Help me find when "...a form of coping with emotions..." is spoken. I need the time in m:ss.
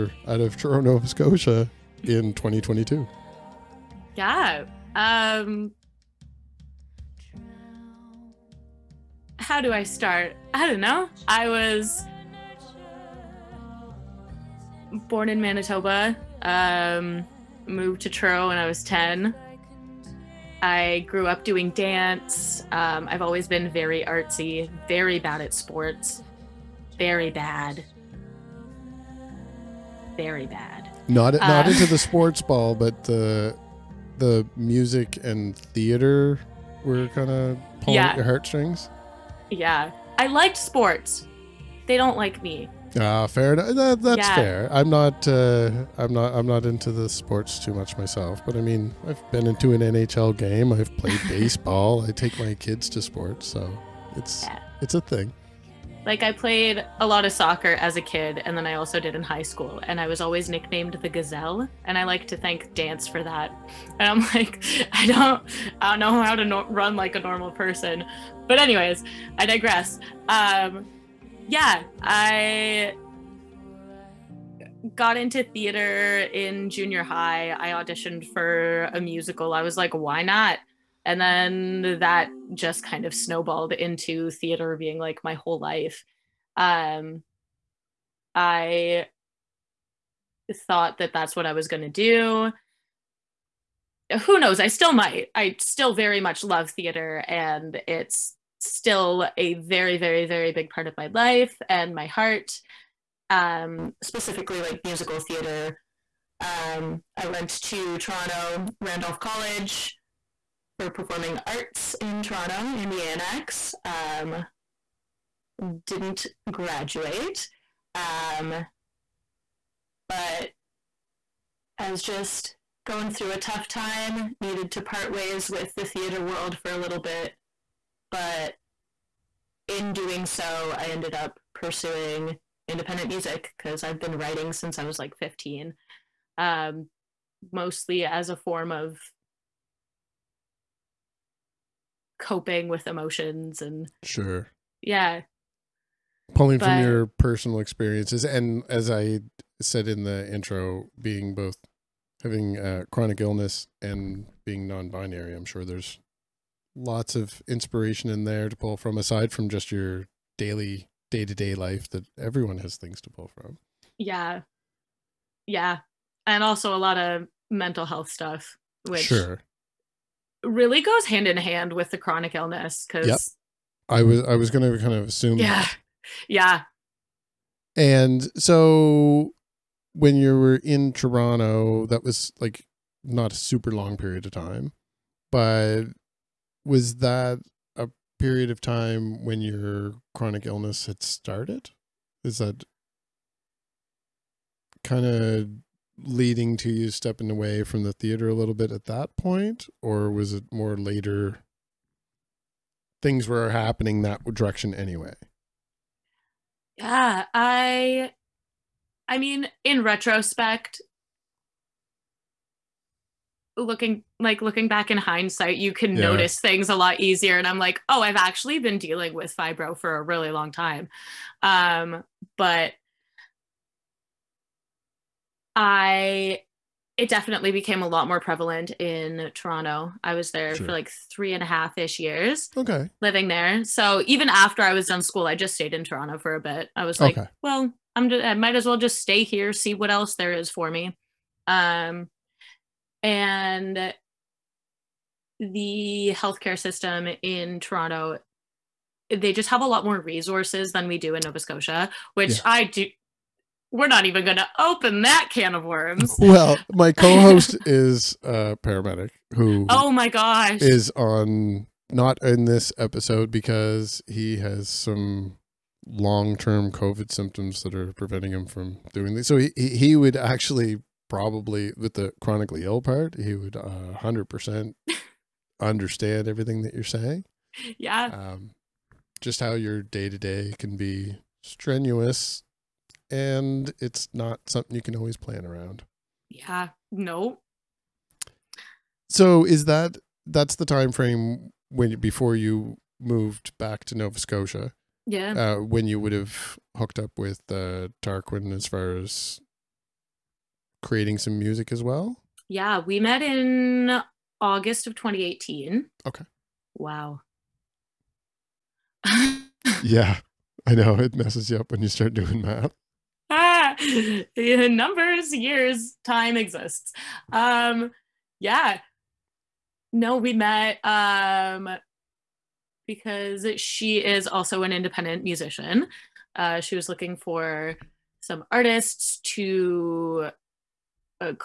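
2:18.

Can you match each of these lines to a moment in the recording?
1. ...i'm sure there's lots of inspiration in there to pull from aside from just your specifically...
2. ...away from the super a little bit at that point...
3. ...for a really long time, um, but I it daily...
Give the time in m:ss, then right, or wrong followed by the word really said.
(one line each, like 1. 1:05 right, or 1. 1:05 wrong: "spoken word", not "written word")
1. 2:35 wrong: "daily", not "specifically"
2. 3:17 wrong: "theater", not "super"
3. 3:39 wrong: "definitely", not "daily".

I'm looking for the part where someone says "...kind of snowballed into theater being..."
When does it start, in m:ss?
1:22.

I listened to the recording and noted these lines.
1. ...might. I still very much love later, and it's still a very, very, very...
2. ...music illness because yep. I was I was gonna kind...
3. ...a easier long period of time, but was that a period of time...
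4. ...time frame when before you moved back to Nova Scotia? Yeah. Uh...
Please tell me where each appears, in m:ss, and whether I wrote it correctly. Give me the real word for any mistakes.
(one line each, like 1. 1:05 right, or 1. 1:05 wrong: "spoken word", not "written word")
1. 1:34 wrong: "theater", not "later"
2. 2:51 wrong: "chronic", not "music"
3. 3:03 wrong: "super", not "easier"
4. 4:50 right.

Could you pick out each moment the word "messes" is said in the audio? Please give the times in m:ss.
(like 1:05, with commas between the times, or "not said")
5:11.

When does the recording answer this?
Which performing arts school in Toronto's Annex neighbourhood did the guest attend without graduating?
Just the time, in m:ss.
1:48.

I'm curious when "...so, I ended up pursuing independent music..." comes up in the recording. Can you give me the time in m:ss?
2:10.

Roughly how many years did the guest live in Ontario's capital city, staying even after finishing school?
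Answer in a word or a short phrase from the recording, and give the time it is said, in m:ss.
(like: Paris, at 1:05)
3 and a half, at 3:51.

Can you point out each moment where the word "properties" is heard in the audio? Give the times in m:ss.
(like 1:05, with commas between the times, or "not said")
not said.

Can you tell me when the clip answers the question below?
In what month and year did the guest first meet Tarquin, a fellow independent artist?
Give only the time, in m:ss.
5:04.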